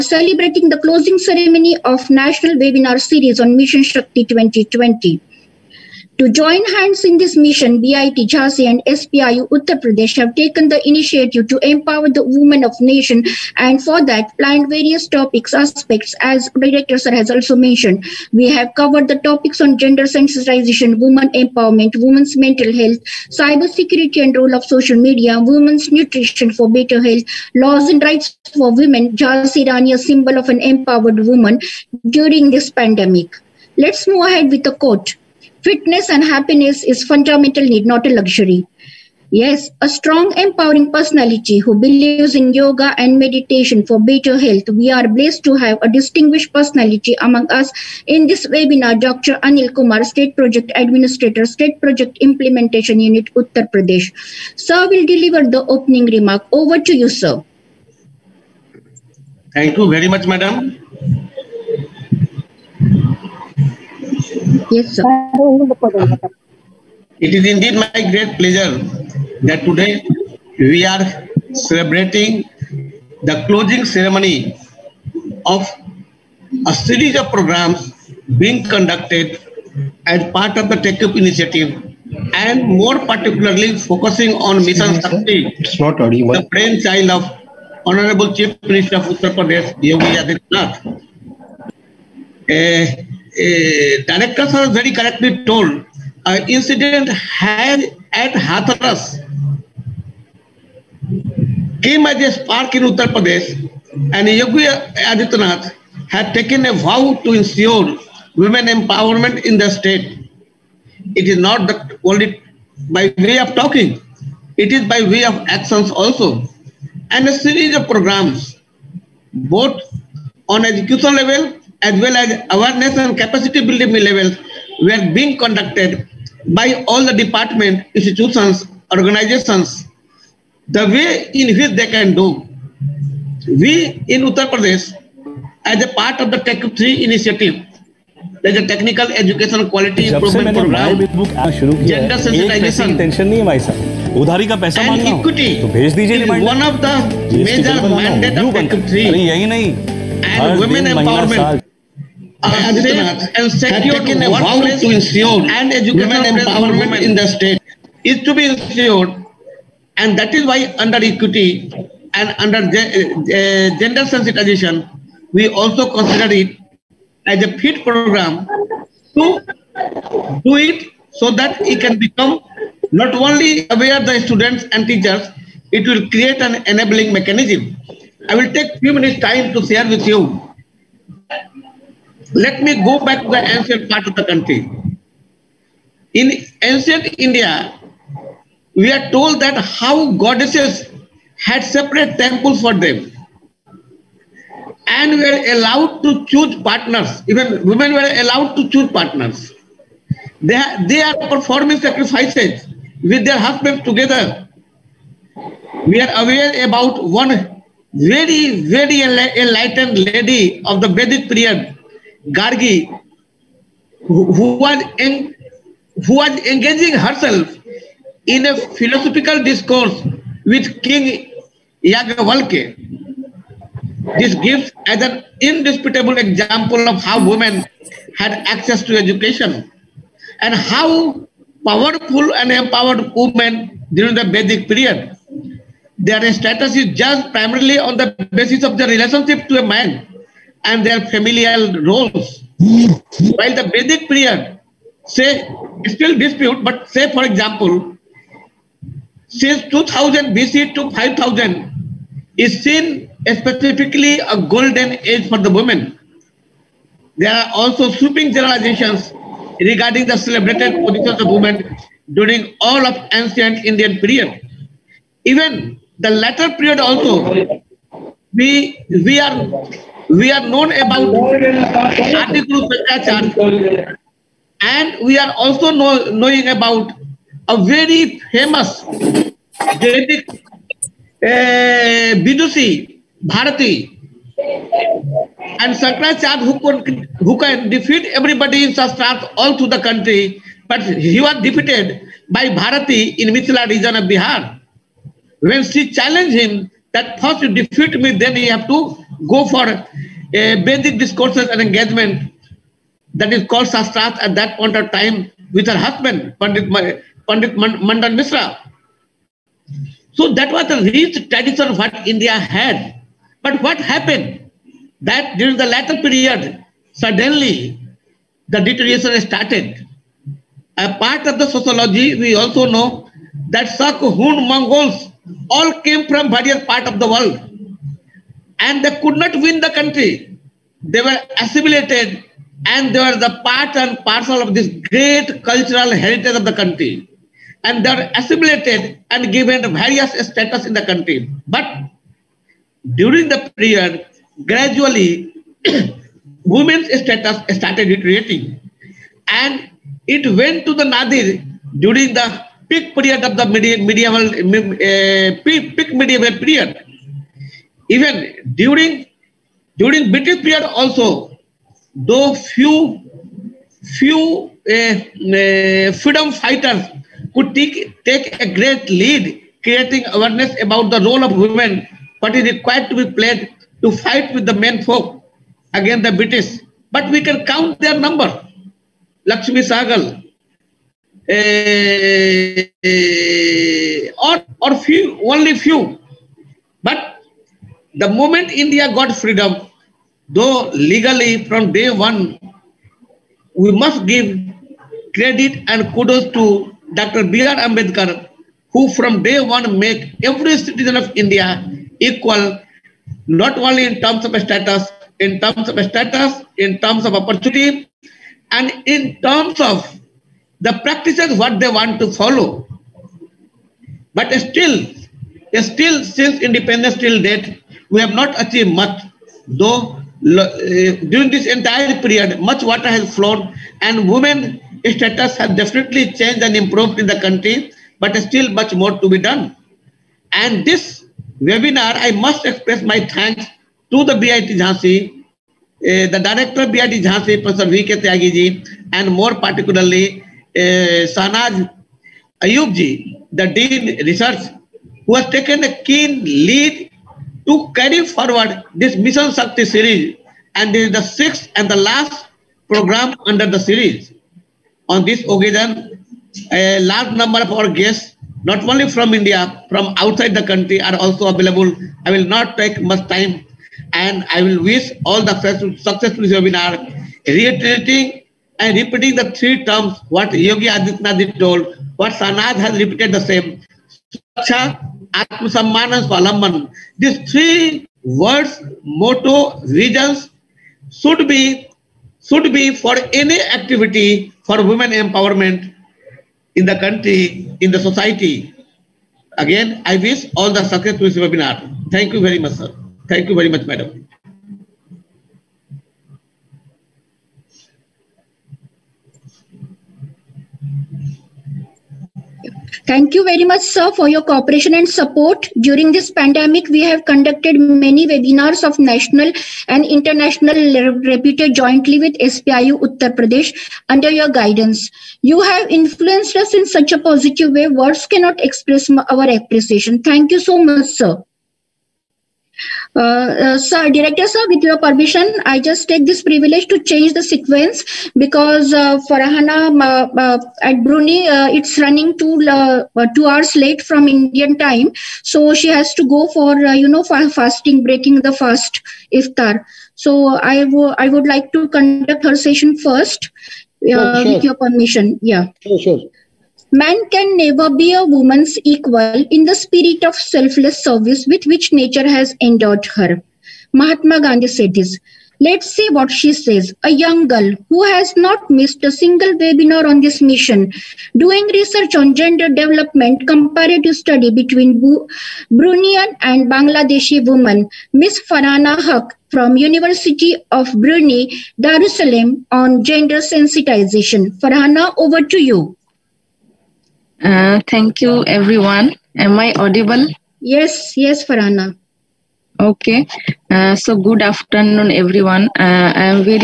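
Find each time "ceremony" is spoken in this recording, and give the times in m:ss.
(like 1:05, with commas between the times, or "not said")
0:01, 1:13.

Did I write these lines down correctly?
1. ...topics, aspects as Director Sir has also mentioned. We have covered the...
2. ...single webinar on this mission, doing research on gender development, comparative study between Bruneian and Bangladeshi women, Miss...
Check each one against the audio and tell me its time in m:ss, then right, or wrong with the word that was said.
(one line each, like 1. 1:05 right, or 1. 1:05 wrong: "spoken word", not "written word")
1. 0:15 right
2. 9:18 right.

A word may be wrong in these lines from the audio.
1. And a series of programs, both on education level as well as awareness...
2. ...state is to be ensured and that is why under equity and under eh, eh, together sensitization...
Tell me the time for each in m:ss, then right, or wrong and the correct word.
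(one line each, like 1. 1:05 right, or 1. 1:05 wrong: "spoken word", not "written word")
1. 1:57 right
2. 2:37 wrong: "gender", not "together".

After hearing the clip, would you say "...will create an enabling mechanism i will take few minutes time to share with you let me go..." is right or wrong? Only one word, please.
right.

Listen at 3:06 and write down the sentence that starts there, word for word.
In ancient India, we are told that how goddesses had separate temples for them and were allowed to choose partners.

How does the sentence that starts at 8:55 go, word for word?
So she has to go for, you know, for fasting, breaking the fast iftar.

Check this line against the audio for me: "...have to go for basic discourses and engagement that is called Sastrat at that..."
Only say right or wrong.
right.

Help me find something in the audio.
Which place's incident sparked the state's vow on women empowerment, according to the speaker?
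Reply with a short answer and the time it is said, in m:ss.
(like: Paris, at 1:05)
Hathras, at 1:38.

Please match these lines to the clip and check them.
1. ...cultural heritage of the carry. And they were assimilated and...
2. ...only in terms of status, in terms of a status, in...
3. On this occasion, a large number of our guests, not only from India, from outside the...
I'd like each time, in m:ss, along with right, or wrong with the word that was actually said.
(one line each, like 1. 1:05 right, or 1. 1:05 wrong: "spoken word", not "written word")
1. 5:35 wrong: "country", not "carry"
2. 6:43 right
3. 7:34 right.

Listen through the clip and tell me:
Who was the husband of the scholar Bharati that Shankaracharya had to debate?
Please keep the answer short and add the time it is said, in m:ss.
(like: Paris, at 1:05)
Mandan Misra, at 5:07.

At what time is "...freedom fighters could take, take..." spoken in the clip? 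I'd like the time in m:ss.
6:05.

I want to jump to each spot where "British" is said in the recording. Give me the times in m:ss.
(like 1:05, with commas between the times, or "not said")
6:00, 6:16.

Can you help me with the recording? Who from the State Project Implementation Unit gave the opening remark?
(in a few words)
Dr. Anil Kumar.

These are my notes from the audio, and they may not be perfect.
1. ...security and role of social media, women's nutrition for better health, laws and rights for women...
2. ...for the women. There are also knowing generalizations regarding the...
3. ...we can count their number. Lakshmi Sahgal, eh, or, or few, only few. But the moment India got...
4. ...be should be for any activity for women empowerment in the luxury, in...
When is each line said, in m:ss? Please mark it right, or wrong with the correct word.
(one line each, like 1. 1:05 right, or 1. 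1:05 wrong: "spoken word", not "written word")
1. 0:23 right
2. 4:15 wrong: "sweeping", not "knowing"
3. 6:17 right
4. 8:01 wrong: "country", not "luxury".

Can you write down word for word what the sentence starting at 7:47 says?
reiterating and repeating the three terms what Yogi Adityanath told, what Sanad has repeated the same.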